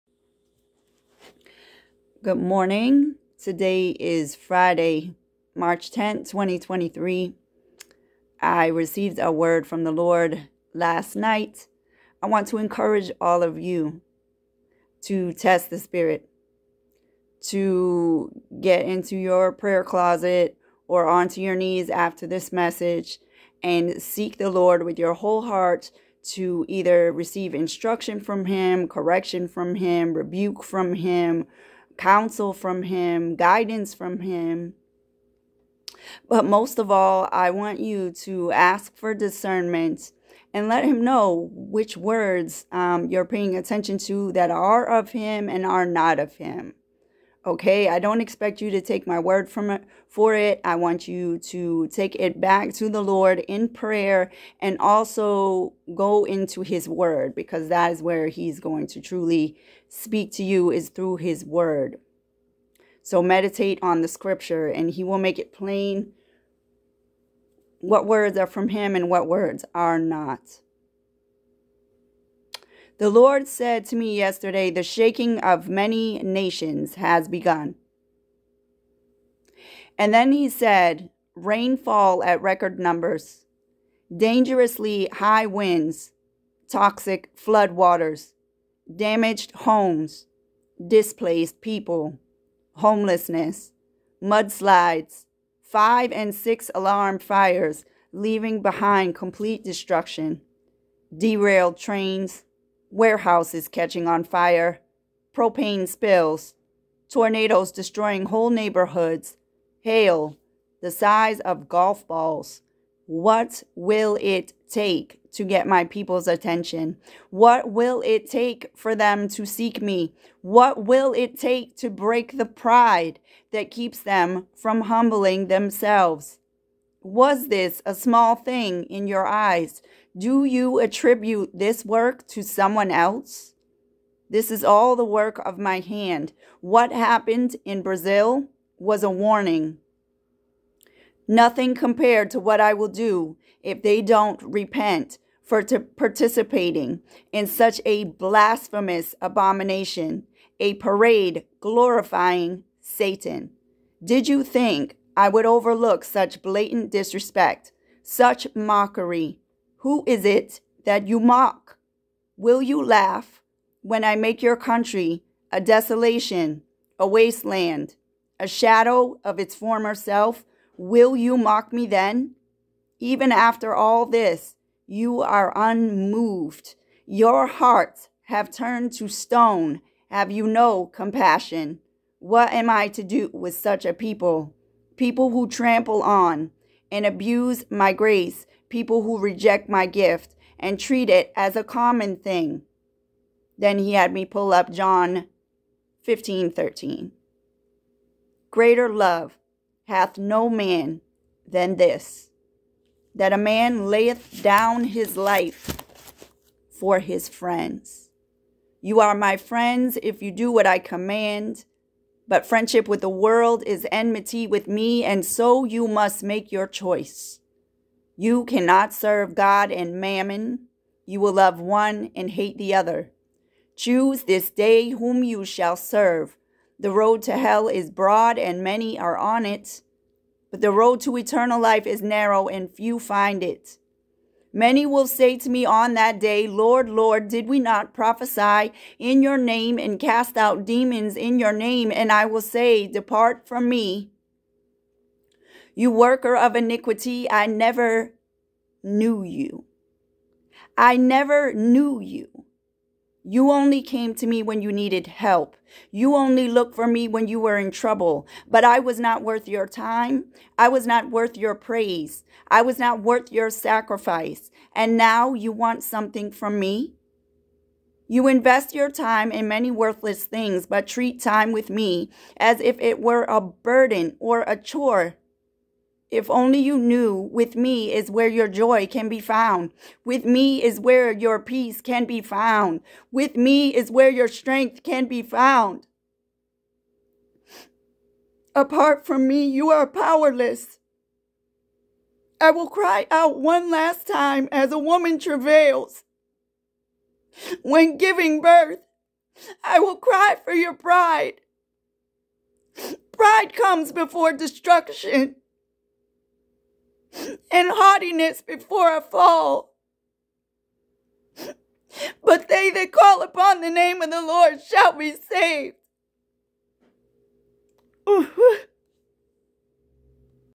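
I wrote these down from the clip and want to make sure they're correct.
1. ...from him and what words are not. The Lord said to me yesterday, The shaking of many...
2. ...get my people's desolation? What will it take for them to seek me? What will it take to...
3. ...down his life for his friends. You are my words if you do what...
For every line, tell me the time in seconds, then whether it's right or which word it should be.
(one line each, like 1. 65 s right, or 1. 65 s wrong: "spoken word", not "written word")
1. 68 s right
2. 115 s wrong: "attention", not "desolation"
3. 204 s wrong: "friends", not "words".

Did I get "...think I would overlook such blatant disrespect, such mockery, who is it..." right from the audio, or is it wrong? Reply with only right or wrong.
right.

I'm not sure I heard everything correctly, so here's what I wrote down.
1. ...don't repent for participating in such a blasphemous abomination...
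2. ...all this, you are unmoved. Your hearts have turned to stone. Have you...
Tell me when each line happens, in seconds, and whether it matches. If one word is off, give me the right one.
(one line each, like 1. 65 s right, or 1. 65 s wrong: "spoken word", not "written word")
1. 144 s right
2. 173 s right.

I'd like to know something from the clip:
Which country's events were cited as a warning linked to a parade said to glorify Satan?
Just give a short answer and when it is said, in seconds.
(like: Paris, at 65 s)
Brazil, at 137 s.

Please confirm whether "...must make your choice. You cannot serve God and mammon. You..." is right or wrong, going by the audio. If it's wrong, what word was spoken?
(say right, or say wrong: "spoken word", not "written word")
right.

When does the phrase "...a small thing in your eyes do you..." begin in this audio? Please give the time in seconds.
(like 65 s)
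127 s.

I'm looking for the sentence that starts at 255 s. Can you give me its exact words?
You only looked for me when you were in trouble.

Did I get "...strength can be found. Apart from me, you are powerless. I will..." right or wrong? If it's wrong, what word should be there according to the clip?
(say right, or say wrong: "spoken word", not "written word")
right.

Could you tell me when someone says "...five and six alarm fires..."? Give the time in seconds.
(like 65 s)
95 s.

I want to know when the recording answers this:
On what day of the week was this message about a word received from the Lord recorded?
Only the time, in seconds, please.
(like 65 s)
4 s.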